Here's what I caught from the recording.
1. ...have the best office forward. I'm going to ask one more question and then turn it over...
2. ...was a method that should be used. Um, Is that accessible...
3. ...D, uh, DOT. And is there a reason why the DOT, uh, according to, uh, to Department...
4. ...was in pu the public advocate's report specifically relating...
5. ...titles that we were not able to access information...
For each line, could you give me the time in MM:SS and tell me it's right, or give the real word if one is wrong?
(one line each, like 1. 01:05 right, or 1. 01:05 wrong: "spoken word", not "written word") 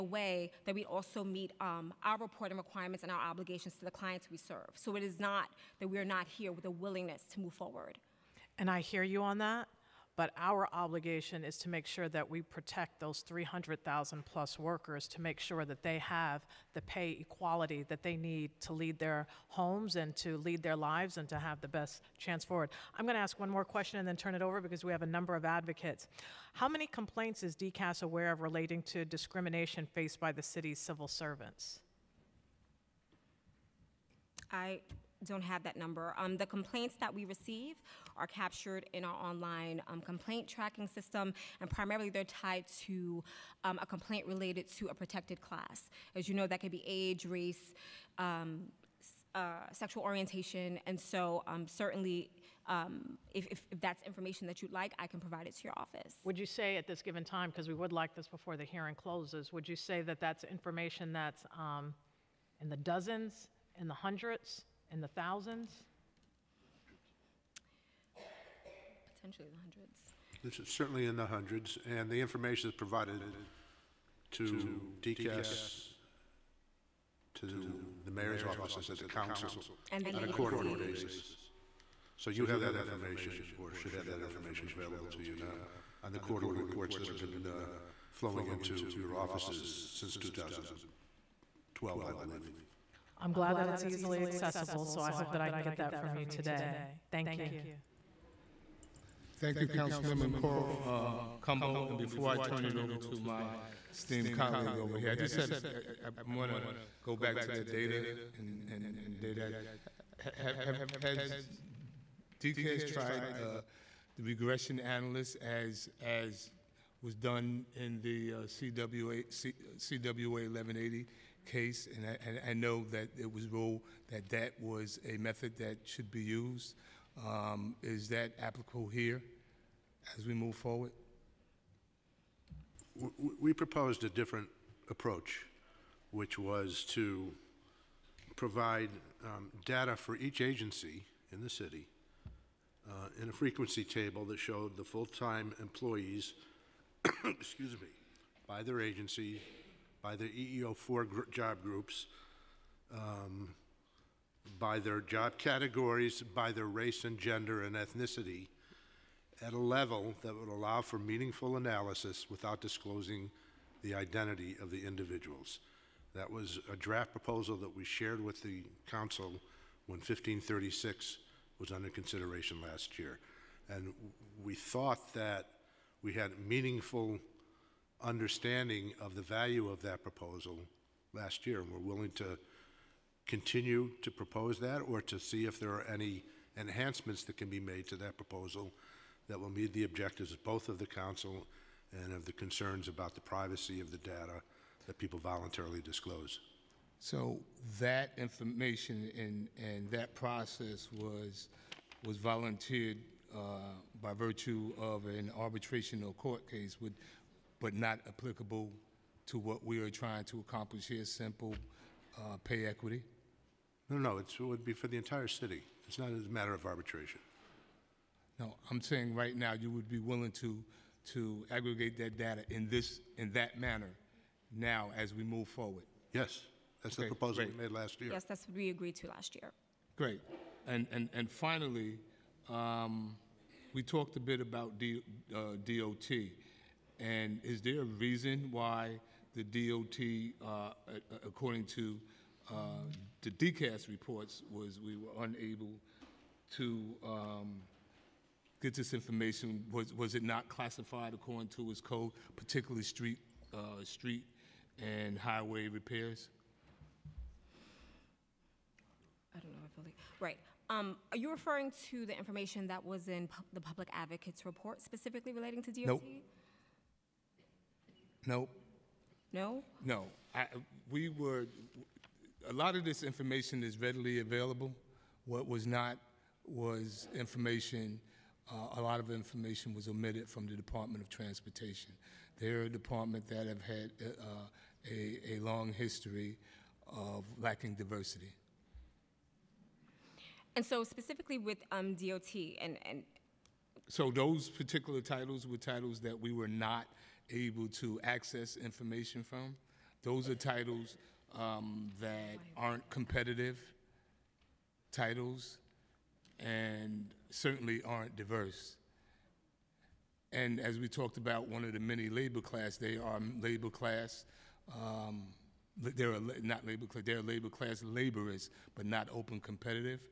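1. 00:21 wrong: "chance", not "office"
2. 02:04 wrong: "applicable", not "accessible"
3. 03:54 wrong: "DCAS", not "Department"
4. 04:22 right
5. 04:55 right.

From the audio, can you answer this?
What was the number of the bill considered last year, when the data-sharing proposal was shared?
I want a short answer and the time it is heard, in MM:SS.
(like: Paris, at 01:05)
1536, at 02:49.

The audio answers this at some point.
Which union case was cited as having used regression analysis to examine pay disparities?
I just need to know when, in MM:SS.
01:59.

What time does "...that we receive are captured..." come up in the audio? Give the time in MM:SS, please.
00:37.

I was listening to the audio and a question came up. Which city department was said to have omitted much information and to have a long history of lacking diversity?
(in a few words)
Department of Transportation.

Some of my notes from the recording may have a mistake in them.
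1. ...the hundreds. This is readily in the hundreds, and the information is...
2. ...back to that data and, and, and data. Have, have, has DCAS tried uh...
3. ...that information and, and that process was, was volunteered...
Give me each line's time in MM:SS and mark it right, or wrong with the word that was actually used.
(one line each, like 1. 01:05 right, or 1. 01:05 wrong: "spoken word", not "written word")
1. 01:09 wrong: "certainly", not "readily"
2. 01:47 right
3. 03:17 right.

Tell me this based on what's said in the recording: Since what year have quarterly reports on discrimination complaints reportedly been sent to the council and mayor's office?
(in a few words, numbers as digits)
2012.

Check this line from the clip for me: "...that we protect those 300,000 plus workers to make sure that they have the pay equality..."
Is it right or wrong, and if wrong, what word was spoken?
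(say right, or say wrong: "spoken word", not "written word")
right.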